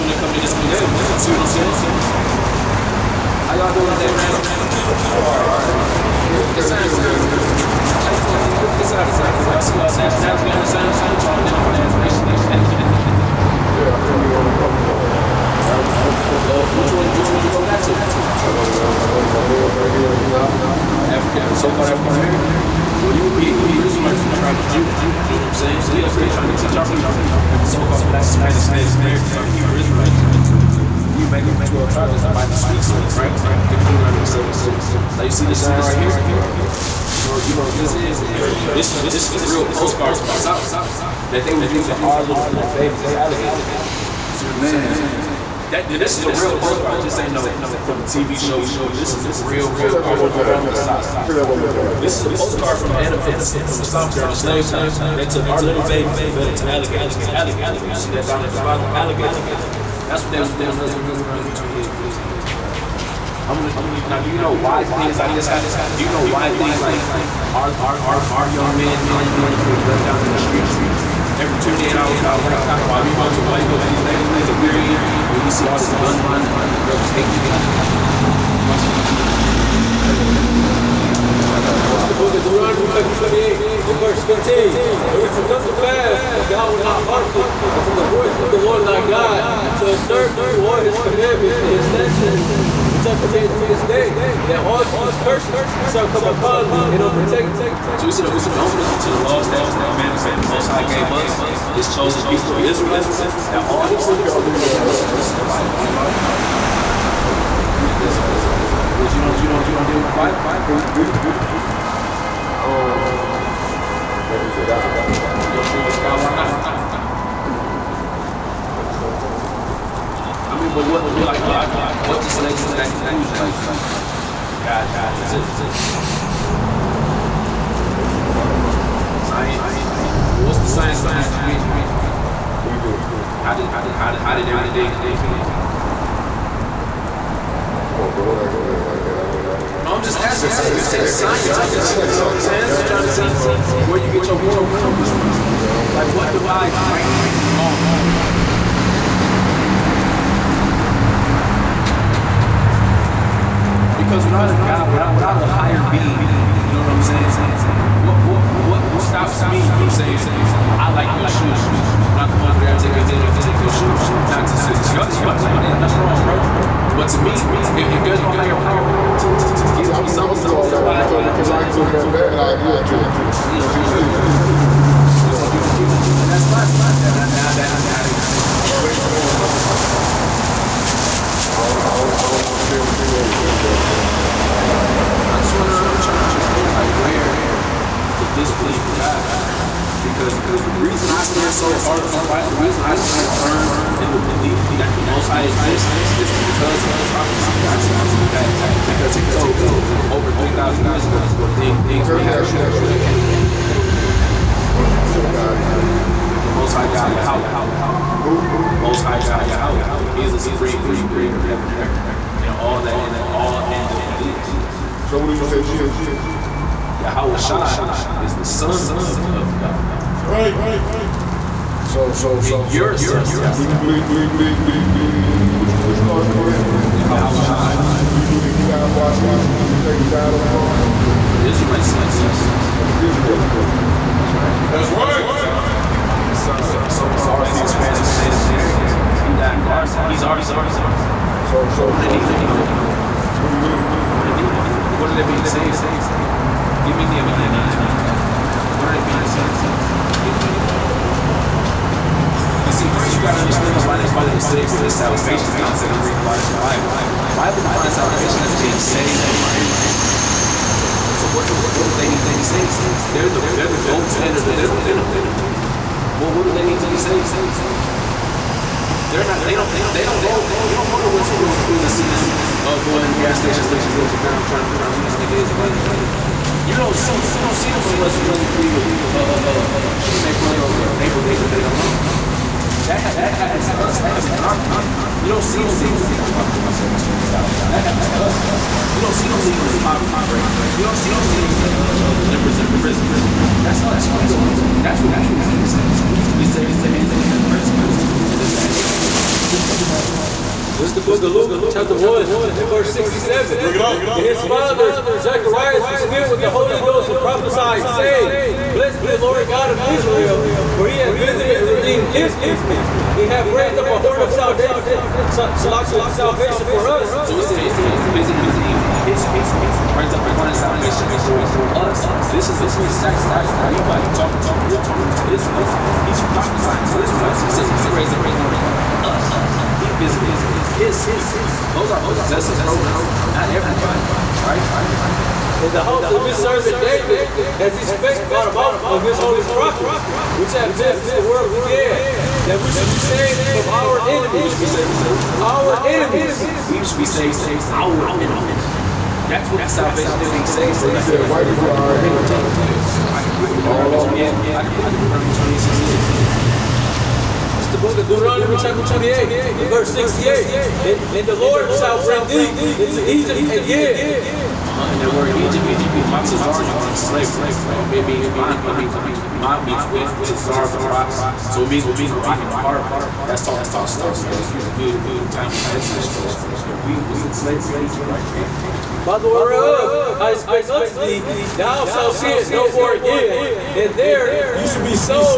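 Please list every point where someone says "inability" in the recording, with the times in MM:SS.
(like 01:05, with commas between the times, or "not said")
not said.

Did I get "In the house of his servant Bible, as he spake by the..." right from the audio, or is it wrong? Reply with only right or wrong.
wrong.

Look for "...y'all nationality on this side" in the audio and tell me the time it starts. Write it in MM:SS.
00:09.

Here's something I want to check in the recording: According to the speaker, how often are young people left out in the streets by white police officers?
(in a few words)
every 28 hours.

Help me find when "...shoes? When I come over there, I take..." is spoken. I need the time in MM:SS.
02:41.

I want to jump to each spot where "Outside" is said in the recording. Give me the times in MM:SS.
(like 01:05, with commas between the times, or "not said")
03:47.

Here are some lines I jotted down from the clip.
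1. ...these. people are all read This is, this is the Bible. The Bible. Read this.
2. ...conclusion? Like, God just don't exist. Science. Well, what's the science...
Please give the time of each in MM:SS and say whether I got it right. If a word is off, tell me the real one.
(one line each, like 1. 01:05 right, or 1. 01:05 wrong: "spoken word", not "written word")
1. 01:43 right
2. 02:02 right.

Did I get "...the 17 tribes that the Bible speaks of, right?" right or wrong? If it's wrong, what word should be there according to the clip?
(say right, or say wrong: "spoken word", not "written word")
wrong: "12", not "17".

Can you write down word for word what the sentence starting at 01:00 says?
That's what they was doing to us.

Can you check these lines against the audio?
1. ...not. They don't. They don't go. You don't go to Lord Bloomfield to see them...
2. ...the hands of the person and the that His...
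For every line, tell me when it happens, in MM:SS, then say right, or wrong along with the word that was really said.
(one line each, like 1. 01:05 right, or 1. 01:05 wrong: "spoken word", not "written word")
1. 04:29 wrong: "West", not "Lord"
2. 04:56 wrong: "This", not "His".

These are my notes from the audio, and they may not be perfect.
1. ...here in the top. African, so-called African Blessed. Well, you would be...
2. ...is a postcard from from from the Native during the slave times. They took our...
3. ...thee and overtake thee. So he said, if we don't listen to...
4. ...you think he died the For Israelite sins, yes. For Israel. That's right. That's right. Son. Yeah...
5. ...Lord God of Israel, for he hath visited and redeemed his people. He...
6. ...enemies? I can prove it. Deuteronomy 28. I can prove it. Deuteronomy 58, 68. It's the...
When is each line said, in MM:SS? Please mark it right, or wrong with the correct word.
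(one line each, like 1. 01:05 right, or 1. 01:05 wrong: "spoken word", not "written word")
1. 00:19 wrong: "American", not "Blessed"
2. 00:52 wrong: "South", not "Native"
3. 01:36 right
4. 03:49 right
5. 05:09 right
6. 05:51 wrong: "28", not "58".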